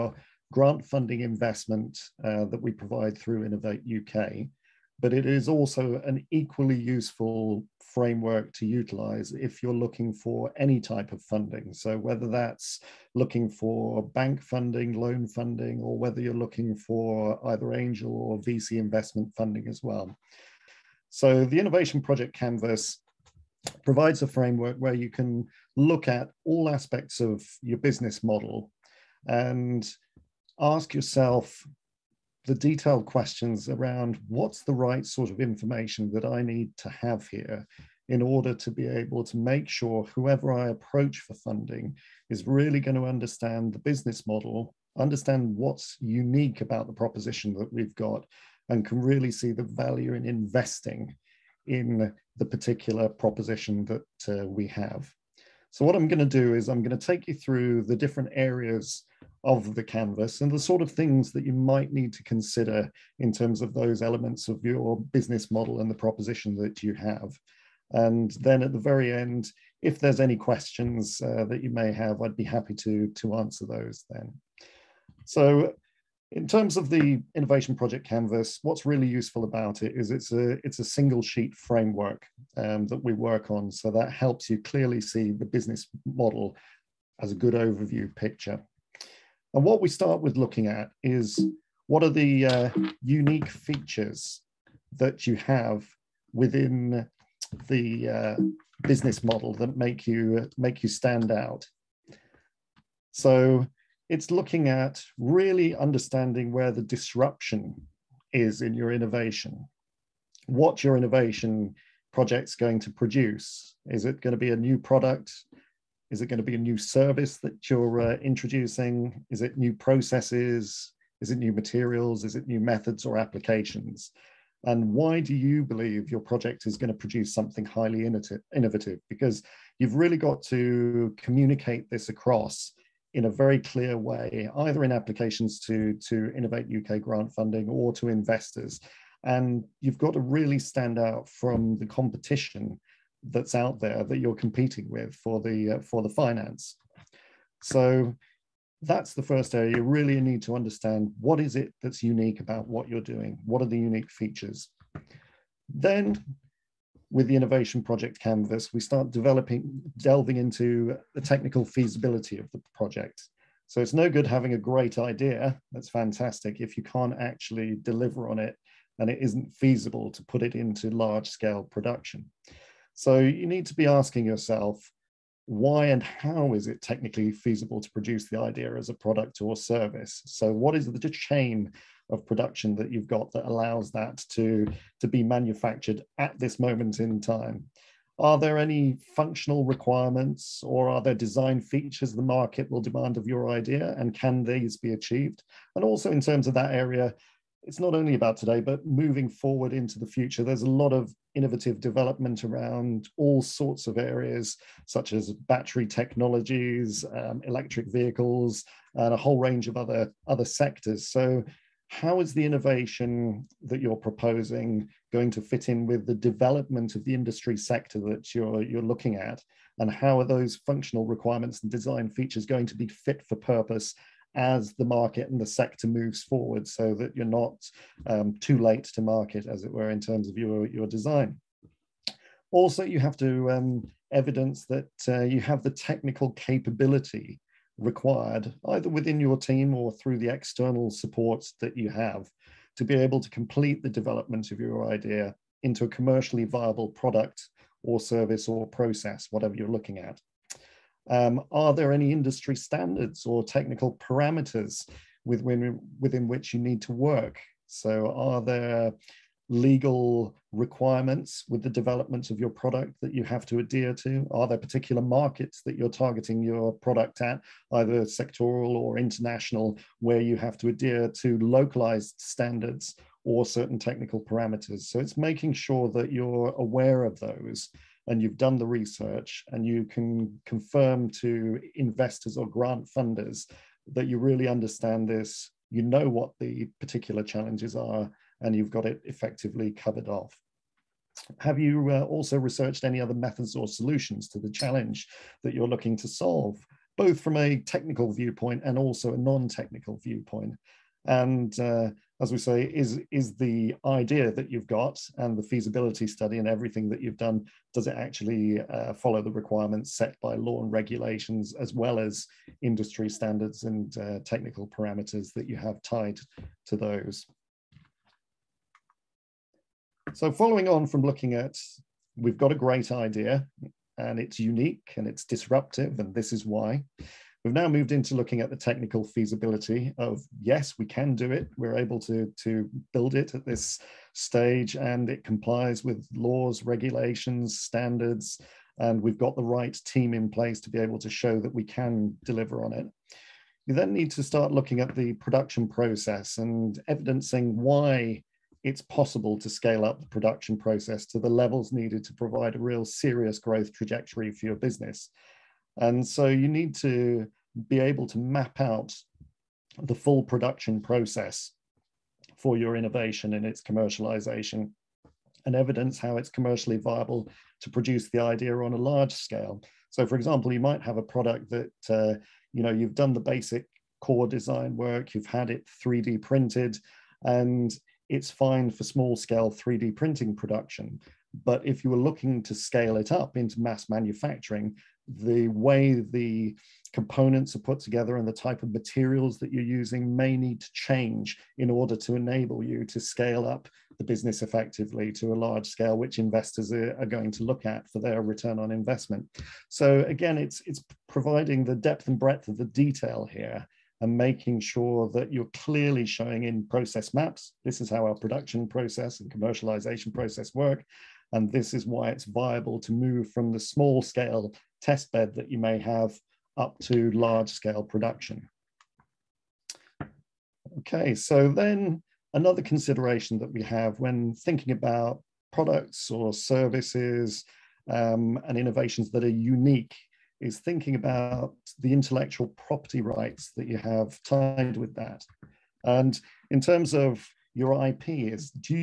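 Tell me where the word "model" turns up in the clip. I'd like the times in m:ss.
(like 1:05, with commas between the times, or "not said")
0:28, 0:44, 1:05, 1:26, 1:39.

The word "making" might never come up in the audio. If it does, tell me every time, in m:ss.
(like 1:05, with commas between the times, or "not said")
4:35, 6:44.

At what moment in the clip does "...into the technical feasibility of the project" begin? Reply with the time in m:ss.
2:40.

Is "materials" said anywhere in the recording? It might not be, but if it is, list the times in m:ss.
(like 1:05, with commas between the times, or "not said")
2:01, 6:28.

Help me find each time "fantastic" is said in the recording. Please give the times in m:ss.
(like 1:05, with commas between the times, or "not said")
2:45.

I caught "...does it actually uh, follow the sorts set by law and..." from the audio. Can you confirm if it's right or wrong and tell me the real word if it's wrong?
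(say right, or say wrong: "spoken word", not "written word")
wrong: "requirements", not "sorts".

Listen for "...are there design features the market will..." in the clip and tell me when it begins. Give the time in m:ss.
3:10.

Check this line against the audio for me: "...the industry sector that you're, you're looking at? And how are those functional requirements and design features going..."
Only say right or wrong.
right.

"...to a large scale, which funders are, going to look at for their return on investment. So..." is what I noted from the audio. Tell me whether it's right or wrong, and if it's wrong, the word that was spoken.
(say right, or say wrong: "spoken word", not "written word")
wrong: "investors", not "funders".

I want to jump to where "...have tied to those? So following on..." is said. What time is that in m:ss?
5:15.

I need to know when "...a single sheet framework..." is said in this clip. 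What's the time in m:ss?
1:20.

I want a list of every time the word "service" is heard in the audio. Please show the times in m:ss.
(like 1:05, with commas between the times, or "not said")
1:56, 2:59, 4:08, 7:06.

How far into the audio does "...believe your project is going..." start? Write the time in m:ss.
2:05.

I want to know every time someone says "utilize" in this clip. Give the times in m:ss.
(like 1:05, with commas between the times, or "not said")
0:08.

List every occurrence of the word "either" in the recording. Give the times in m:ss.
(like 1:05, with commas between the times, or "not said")
0:17, 2:14, 3:58, 4:27.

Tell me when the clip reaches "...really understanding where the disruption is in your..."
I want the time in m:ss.
1:45.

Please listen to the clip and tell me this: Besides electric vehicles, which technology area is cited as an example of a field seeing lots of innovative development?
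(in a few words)
battery technologies.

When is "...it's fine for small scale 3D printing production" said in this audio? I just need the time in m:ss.
6:18.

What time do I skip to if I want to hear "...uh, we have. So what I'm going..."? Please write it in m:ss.
0:54.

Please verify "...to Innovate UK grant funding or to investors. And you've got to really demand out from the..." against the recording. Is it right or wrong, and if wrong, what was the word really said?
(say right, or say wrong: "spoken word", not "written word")
wrong: "stand", not "demand".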